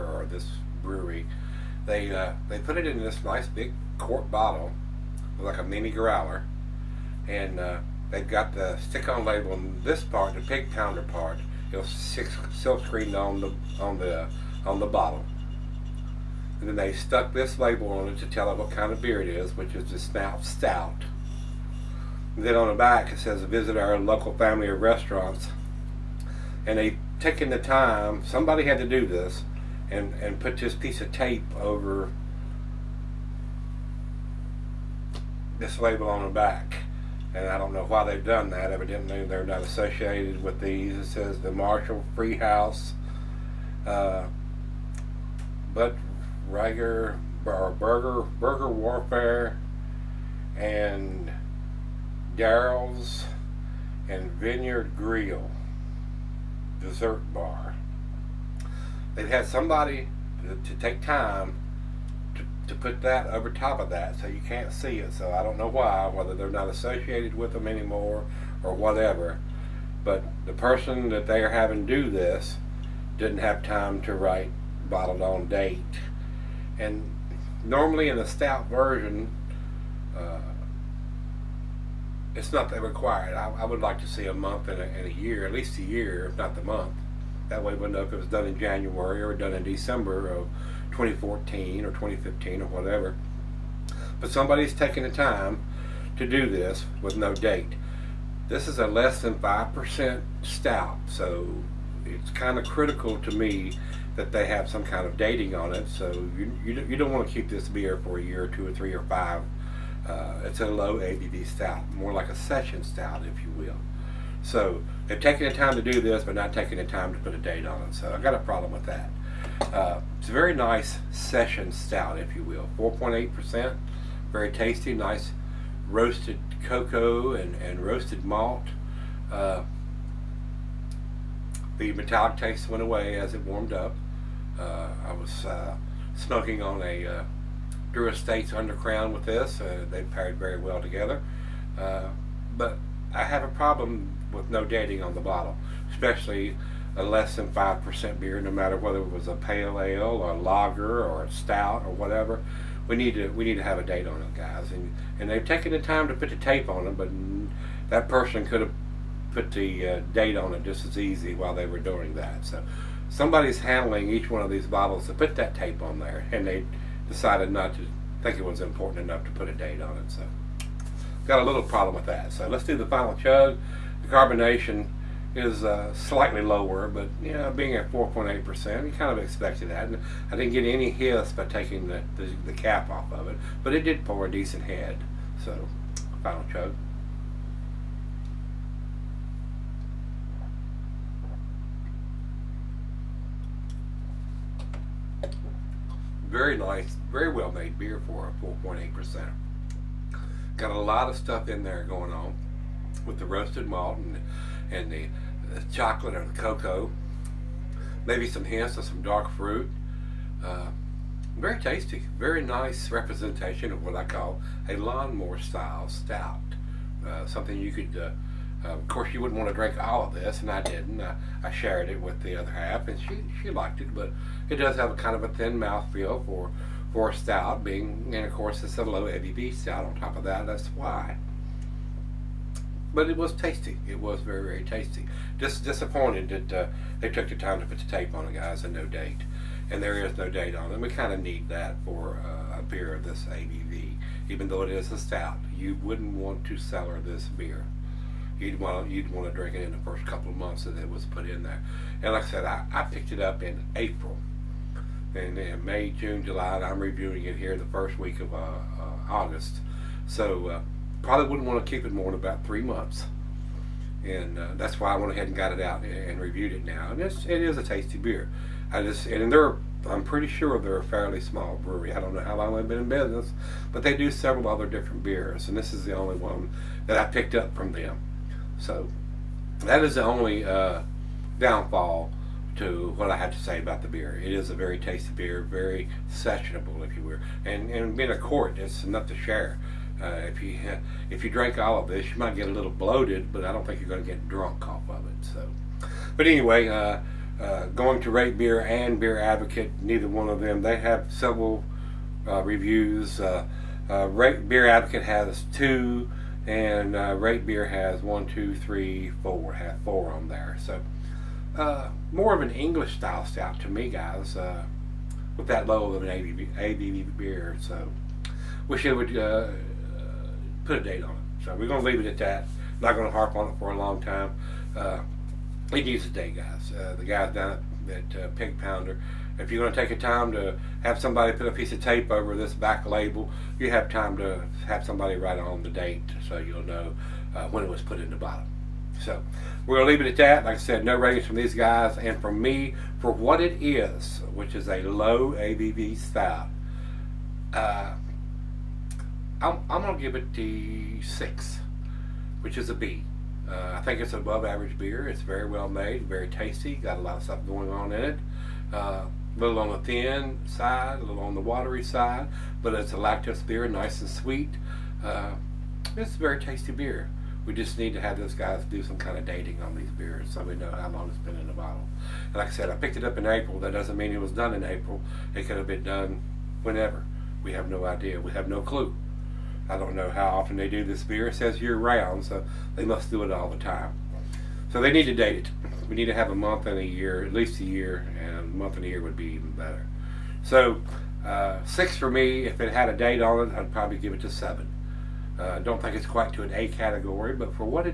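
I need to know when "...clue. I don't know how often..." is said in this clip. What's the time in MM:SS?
06:18.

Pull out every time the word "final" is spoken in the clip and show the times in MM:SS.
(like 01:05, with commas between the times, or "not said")
02:52, 03:06.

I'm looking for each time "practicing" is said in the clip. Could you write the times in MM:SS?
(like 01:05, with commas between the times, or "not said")
not said.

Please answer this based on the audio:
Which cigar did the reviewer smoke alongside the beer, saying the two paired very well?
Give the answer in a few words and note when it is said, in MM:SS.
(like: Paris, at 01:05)
Drew Estates Undercrown, at 02:17.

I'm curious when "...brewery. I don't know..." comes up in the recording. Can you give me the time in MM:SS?
04:31.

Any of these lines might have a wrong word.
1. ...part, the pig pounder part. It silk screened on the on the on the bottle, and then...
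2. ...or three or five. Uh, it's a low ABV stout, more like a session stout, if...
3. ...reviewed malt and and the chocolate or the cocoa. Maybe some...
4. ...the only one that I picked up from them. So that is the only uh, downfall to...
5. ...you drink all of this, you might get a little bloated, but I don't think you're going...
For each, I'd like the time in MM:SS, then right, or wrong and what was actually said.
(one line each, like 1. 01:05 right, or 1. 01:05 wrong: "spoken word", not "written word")
1. 00:10 right
2. 01:48 right
3. 03:23 wrong: "roasted", not "reviewed"
4. 04:35 right
5. 04:51 right.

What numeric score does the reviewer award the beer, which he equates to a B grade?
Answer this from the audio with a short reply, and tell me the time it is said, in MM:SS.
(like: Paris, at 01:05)
6, at 05:50.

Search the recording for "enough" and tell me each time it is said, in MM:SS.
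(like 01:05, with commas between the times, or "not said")
02:49, 04:48.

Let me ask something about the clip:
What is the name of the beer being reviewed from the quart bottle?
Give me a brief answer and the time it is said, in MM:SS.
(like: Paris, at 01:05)
Snout Stout, at 00:19.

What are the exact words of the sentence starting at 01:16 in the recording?
And normally in the stout version, uh, it's not that required.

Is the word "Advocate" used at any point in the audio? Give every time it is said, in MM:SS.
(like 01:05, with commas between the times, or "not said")
04:59, 05:04.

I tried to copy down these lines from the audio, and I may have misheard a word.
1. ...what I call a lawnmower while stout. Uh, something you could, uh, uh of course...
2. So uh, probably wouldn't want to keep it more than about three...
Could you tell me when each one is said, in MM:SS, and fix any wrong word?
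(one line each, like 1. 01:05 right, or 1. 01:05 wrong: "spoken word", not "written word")
1. 03:33 wrong: "style", not "while"
2. 04:20 right.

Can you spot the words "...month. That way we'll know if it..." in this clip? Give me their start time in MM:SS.
01:26.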